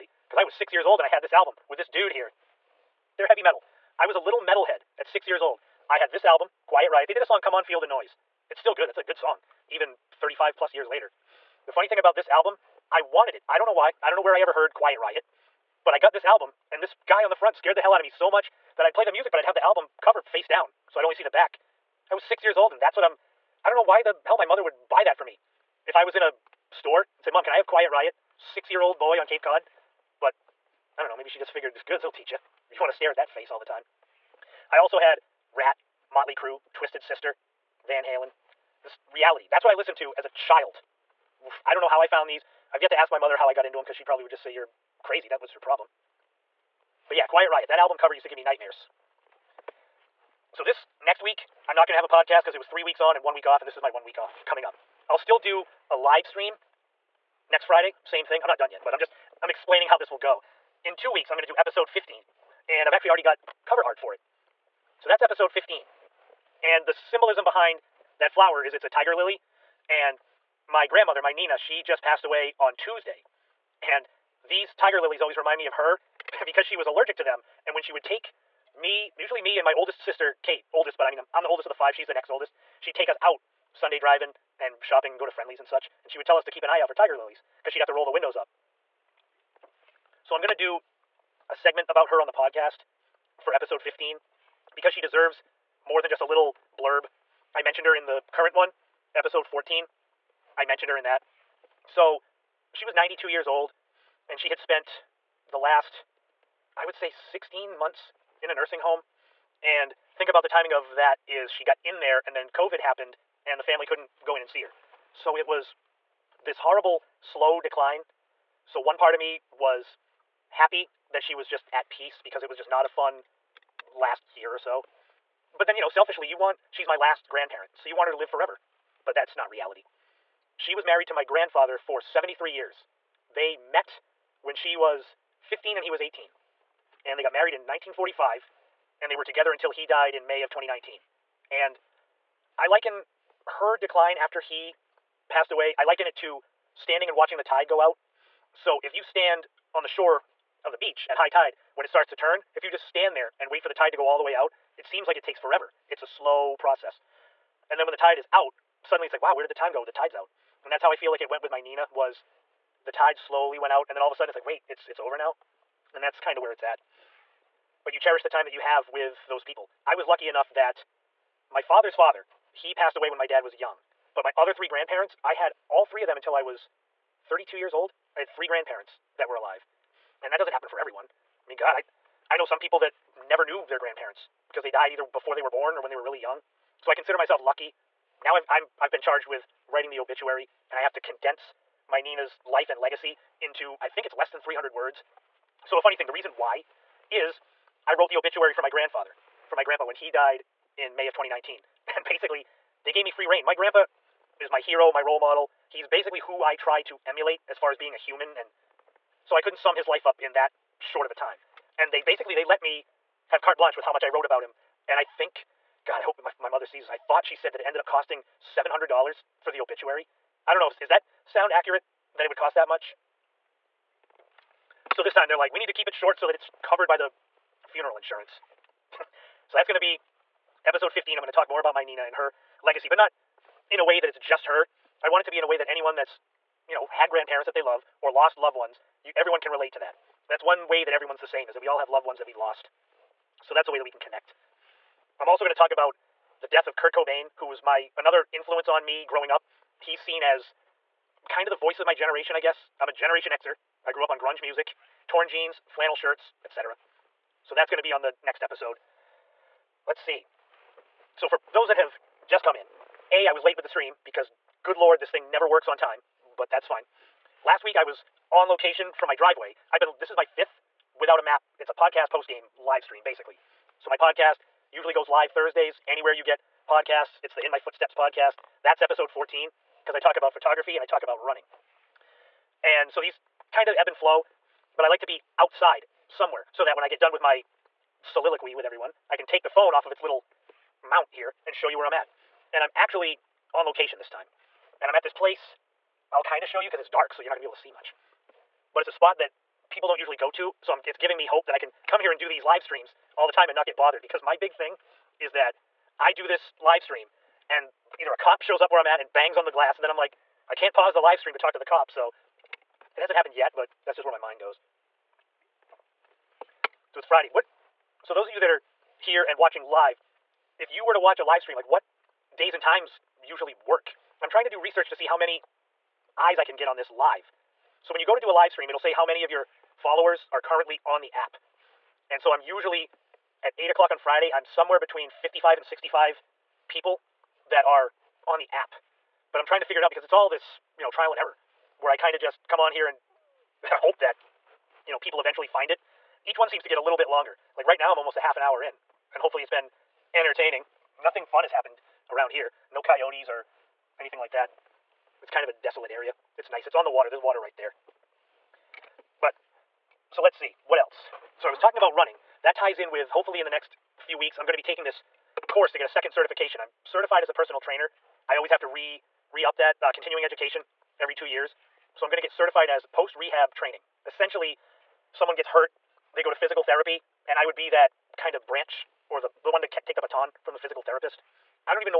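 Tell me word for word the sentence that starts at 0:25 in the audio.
If I was in a store and said, Mom, can I have Quiet Riot?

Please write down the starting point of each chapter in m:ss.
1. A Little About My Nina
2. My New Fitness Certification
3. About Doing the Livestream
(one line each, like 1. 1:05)
1. 1:00
2. 6:01
3. 4:20.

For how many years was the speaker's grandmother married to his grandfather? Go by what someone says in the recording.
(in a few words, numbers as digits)
73.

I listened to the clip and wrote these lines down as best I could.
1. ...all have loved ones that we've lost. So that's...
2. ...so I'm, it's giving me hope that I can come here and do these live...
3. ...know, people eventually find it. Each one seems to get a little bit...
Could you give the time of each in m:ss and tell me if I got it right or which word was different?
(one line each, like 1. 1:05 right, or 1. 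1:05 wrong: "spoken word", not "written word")
1. 4:01 right
2. 5:00 right
3. 5:44 right.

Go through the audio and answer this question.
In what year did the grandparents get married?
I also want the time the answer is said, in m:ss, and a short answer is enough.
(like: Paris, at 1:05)
1945, at 2:17.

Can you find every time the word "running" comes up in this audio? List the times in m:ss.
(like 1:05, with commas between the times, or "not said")
4:41, 6:01.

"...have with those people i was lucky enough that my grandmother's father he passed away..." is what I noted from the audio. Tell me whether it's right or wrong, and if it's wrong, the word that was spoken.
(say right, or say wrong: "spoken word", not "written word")
wrong: "father", not "grandmother".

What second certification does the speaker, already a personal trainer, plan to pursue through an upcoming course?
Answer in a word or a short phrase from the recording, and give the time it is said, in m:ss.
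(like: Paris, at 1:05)
post rehab training, at 6:12.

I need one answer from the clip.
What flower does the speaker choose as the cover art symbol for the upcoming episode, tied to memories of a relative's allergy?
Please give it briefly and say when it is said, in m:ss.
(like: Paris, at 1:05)
tiger lily, at 1:08.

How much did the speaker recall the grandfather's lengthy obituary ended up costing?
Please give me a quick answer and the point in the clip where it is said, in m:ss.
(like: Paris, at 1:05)
$700, at 3:38.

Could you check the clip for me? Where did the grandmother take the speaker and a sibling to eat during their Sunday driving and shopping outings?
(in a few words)
Friendly's.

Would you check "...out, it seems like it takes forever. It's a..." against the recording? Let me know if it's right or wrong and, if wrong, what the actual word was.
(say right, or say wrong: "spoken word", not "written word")
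right.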